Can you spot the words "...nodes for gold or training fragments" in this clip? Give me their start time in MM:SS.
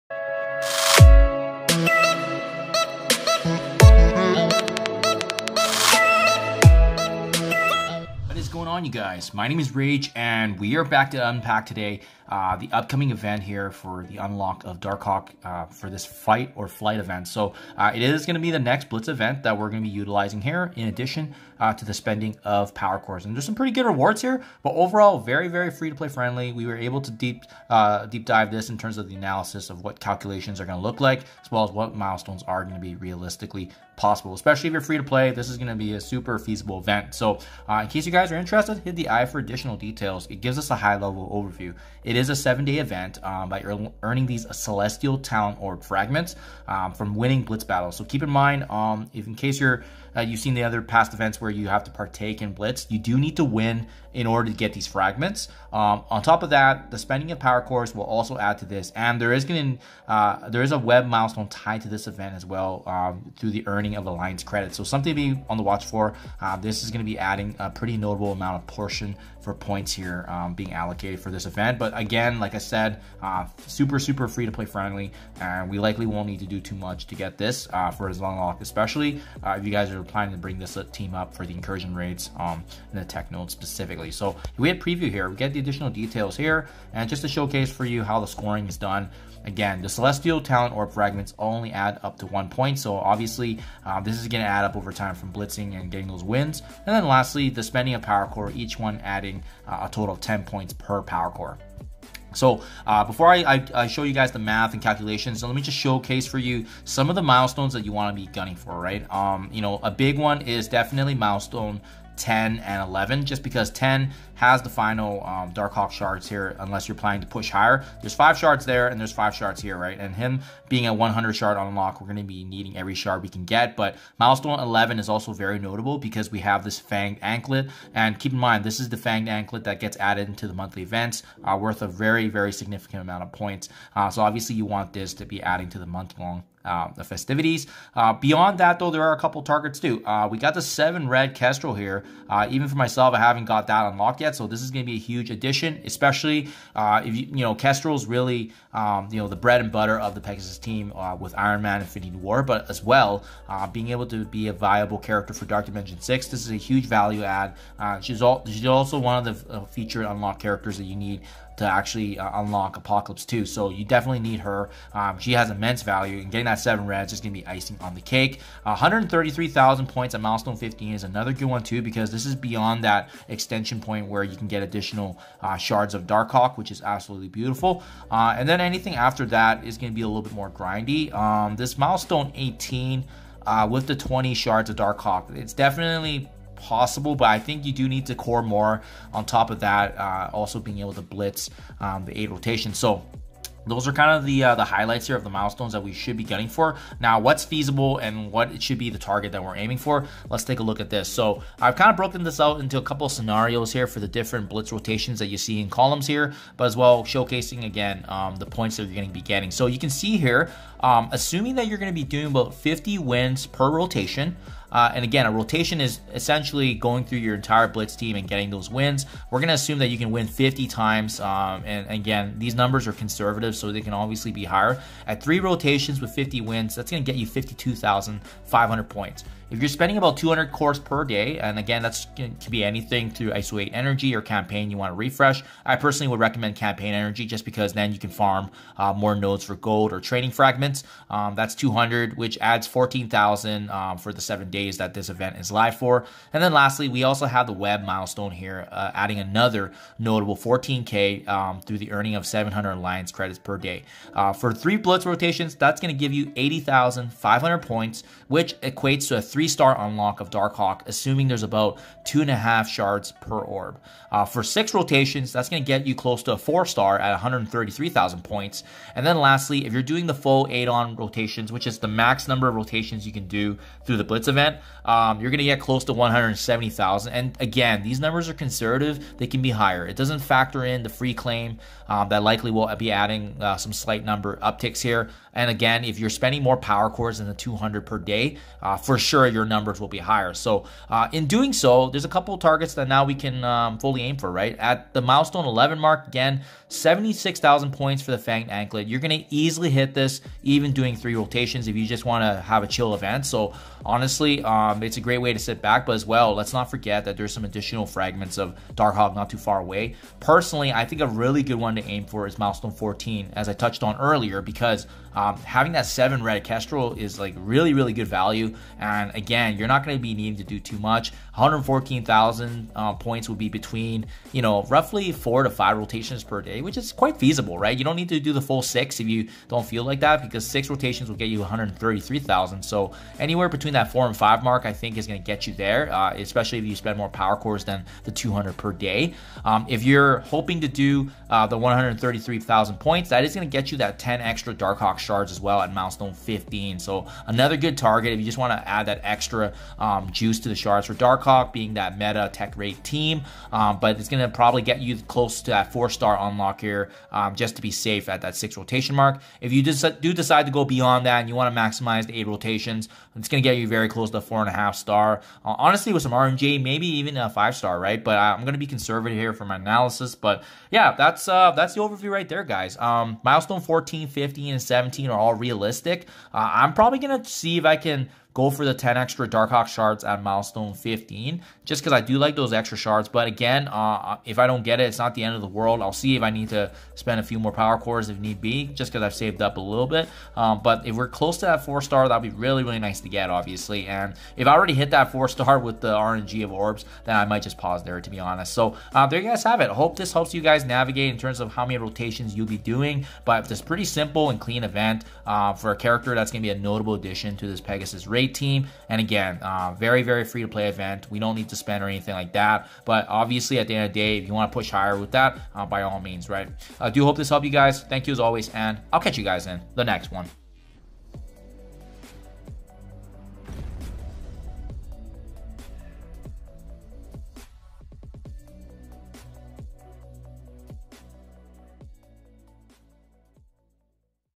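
03:59.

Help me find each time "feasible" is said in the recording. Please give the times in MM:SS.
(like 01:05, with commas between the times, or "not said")
00:36, 03:17, 05:27.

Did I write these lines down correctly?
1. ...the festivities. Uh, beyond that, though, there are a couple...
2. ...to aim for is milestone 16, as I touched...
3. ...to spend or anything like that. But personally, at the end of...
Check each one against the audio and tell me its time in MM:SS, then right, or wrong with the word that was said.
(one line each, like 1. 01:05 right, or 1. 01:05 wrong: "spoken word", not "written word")
1. 02:16 right
2. 05:11 wrong: "14", not "16"
3. 06:51 wrong: "obviously", not "personally".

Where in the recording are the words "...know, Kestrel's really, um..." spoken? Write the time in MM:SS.
02:27.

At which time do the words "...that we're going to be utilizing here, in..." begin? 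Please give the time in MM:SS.
00:19.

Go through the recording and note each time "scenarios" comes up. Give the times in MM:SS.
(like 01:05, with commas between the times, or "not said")
03:23.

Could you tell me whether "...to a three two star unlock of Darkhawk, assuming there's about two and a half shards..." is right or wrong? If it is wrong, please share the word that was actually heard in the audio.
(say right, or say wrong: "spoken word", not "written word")
wrong: "three", not "two".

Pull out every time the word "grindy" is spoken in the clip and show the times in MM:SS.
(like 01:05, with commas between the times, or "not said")
03:00.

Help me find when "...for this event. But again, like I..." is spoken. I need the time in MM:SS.
01:11.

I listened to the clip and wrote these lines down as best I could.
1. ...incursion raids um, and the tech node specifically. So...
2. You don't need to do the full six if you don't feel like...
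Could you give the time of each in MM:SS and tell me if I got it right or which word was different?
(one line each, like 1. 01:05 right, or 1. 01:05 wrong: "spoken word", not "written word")
1. 01:21 right
2. 05:27 right.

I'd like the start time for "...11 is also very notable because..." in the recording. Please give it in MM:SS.
02:04.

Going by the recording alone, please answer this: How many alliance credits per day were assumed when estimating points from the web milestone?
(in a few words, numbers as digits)
700.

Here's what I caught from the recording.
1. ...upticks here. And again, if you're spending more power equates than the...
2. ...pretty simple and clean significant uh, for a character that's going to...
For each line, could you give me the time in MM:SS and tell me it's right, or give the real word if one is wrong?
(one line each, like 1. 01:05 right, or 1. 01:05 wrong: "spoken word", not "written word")
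1. 04:44 wrong: "cores", not "equates"
2. 06:43 wrong: "event", not "significant".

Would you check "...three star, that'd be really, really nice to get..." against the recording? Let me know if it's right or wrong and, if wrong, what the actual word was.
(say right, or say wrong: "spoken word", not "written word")
wrong: "four", not "three".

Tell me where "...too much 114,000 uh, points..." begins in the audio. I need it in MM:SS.
05:20.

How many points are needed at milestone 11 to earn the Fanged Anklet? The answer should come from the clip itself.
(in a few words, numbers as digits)
76,000.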